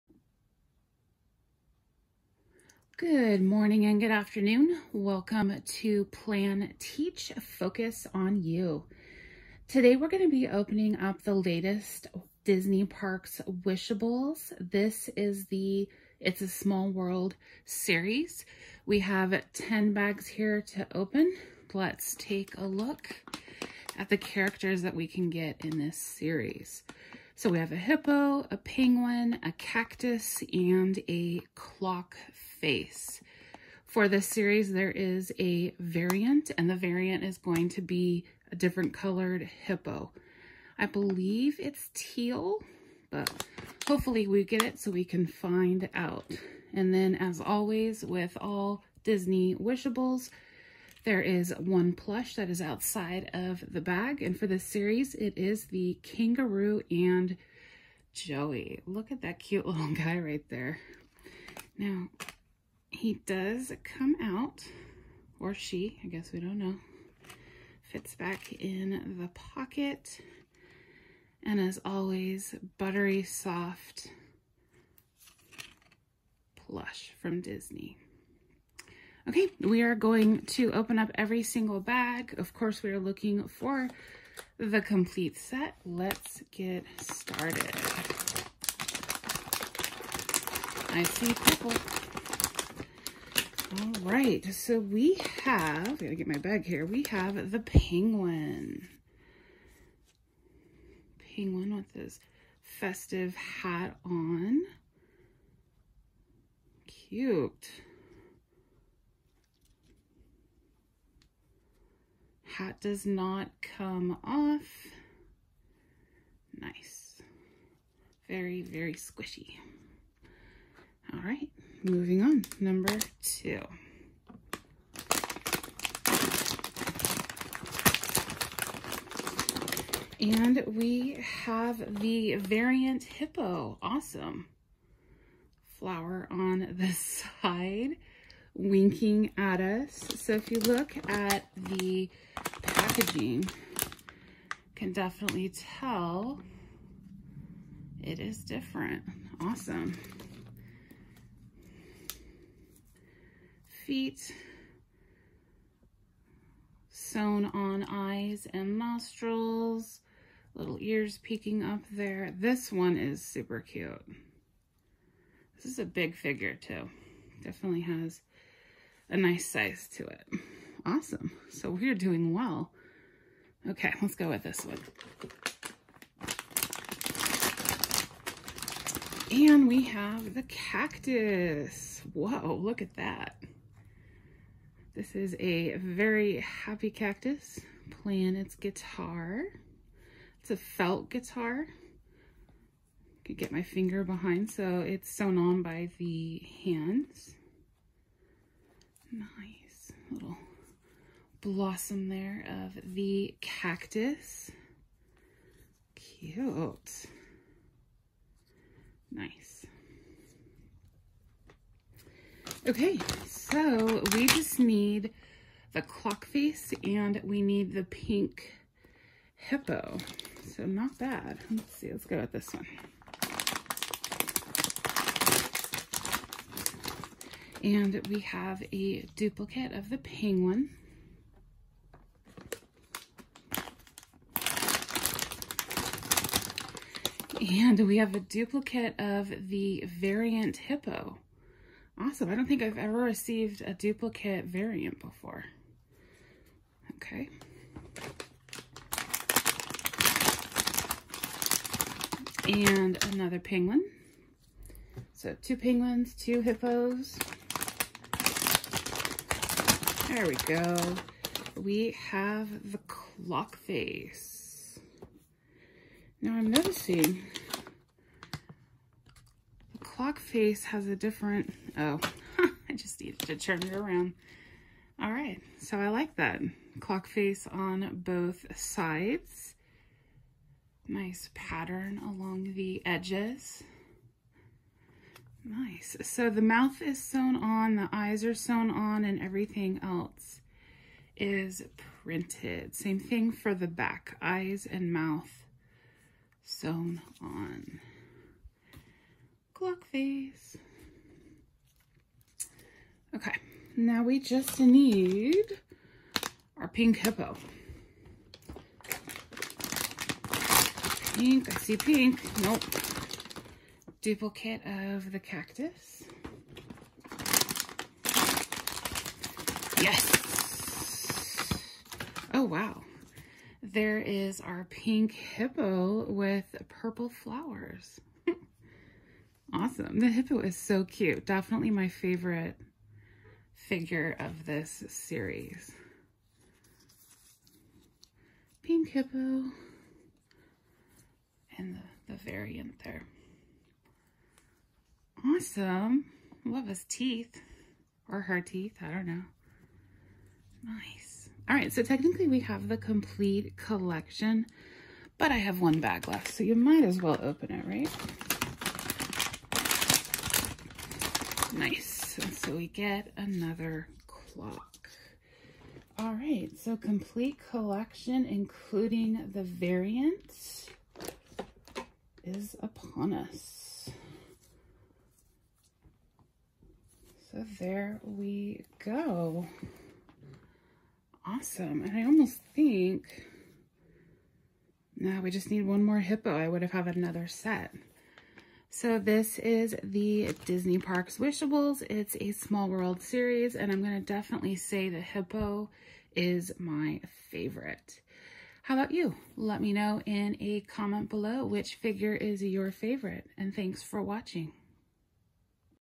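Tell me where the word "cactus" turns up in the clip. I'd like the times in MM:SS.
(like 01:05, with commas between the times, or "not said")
00:29, 03:00, 03:06, 03:23, 05:15.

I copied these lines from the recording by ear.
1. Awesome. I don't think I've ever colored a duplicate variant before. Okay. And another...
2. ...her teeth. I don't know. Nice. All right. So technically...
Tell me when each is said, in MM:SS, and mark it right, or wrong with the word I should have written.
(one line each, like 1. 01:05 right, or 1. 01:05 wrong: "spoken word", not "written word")
1. 04:01 wrong: "received", not "colored"
2. 05:48 right.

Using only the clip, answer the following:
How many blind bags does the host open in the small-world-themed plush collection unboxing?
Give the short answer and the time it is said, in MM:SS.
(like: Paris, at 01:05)
10, at 00:19.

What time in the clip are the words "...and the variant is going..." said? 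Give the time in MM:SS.
00:36.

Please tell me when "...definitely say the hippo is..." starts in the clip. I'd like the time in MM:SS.
06:34.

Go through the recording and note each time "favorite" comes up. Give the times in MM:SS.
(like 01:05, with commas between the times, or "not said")
05:31, 06:37, 06:42.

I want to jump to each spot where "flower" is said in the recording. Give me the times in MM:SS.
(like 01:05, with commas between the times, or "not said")
02:15, 05:27.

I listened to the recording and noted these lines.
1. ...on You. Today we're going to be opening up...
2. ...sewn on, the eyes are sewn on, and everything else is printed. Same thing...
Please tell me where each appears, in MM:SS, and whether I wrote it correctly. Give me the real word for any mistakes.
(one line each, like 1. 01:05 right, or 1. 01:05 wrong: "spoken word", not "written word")
1. 00:08 right
2. 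04:47 right.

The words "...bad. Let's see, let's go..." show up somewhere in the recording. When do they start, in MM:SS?
03:40.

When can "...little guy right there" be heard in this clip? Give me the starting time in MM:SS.
00:59.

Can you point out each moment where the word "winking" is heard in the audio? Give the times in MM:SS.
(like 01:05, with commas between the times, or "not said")
02:18.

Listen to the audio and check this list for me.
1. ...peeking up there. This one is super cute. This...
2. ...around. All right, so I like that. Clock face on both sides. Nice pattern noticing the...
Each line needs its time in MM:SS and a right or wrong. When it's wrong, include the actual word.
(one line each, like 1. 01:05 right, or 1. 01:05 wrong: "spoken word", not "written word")
1. 02:41 right
2. 04:33 wrong: "along", not "noticing".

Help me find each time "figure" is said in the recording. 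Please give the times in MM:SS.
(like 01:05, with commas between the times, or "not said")
02:46, 05:33, 06:41.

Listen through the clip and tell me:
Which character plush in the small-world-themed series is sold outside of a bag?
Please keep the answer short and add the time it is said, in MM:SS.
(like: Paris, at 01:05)
Kangaroo and Joey, at 00:56.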